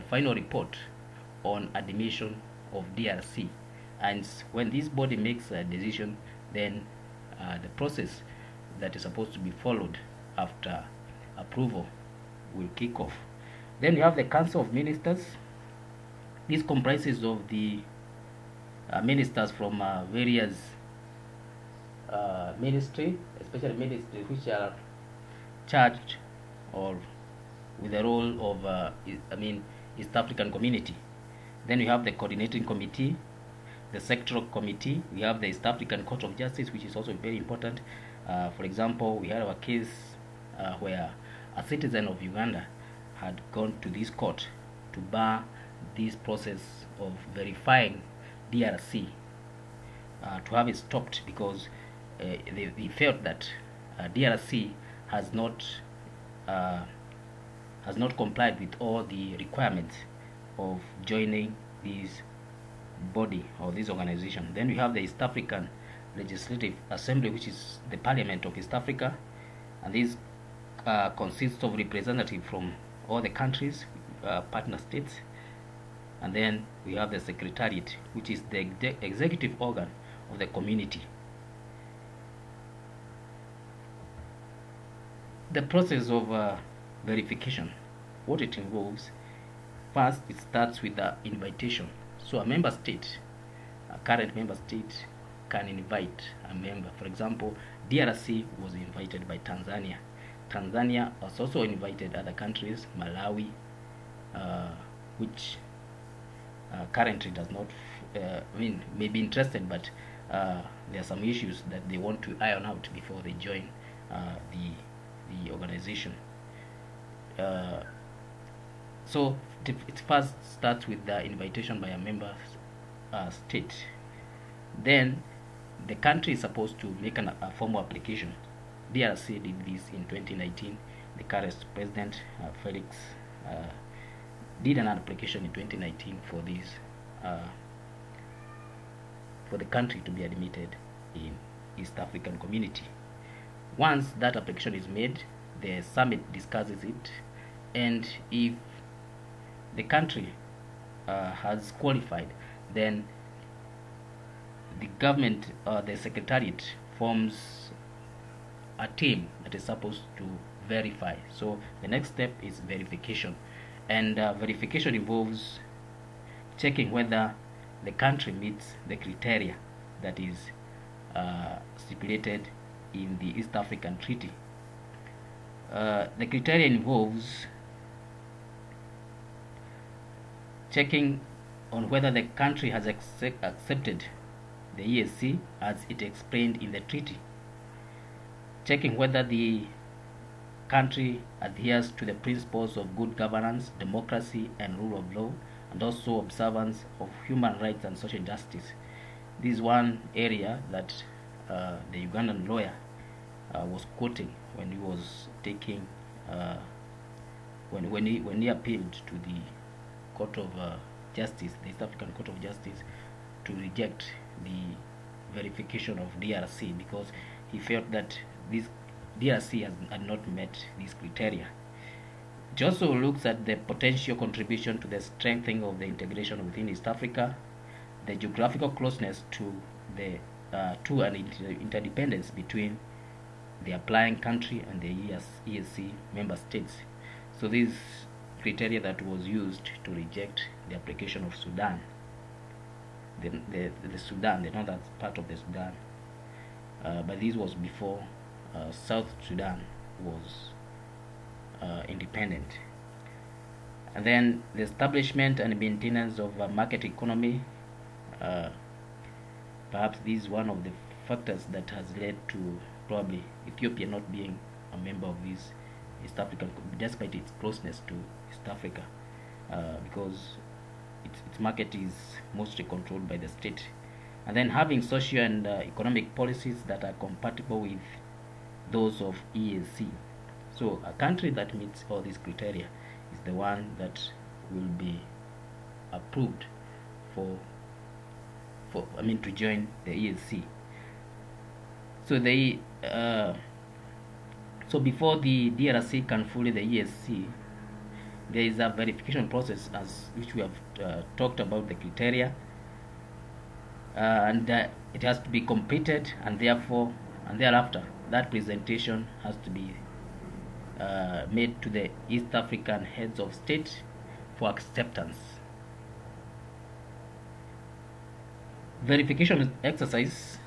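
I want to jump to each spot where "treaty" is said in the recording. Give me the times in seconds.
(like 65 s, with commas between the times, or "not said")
173 s, 186 s.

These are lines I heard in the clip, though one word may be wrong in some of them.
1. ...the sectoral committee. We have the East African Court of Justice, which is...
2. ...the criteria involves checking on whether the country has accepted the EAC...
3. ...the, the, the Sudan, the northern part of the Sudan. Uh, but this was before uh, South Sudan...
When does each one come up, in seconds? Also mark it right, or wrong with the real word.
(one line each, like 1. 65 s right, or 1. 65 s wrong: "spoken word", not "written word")
1. 33 s right
2. 176 s right
3. 243 s right.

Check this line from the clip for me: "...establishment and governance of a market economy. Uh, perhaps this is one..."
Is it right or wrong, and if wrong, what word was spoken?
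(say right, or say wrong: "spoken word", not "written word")
wrong: "maintenance", not "governance".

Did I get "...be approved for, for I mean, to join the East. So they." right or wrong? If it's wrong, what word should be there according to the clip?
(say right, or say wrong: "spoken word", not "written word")
wrong: "EAC", not "East".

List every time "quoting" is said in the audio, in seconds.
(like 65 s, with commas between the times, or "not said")
203 s.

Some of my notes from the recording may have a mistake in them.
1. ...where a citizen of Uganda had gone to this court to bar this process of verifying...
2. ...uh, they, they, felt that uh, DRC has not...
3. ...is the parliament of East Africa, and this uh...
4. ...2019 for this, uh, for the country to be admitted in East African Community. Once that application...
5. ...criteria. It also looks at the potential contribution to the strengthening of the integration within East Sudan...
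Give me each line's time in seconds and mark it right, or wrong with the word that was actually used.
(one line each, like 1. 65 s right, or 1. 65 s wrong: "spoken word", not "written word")
1. 40 s right
2. 52 s right
3. 67 s right
4. 135 s right
5. 220 s wrong: "Africa", not "Sudan".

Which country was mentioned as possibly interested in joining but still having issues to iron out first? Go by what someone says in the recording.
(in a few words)
Malawi.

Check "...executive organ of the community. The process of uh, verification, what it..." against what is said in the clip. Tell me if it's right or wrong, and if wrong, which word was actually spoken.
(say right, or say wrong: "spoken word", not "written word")
right.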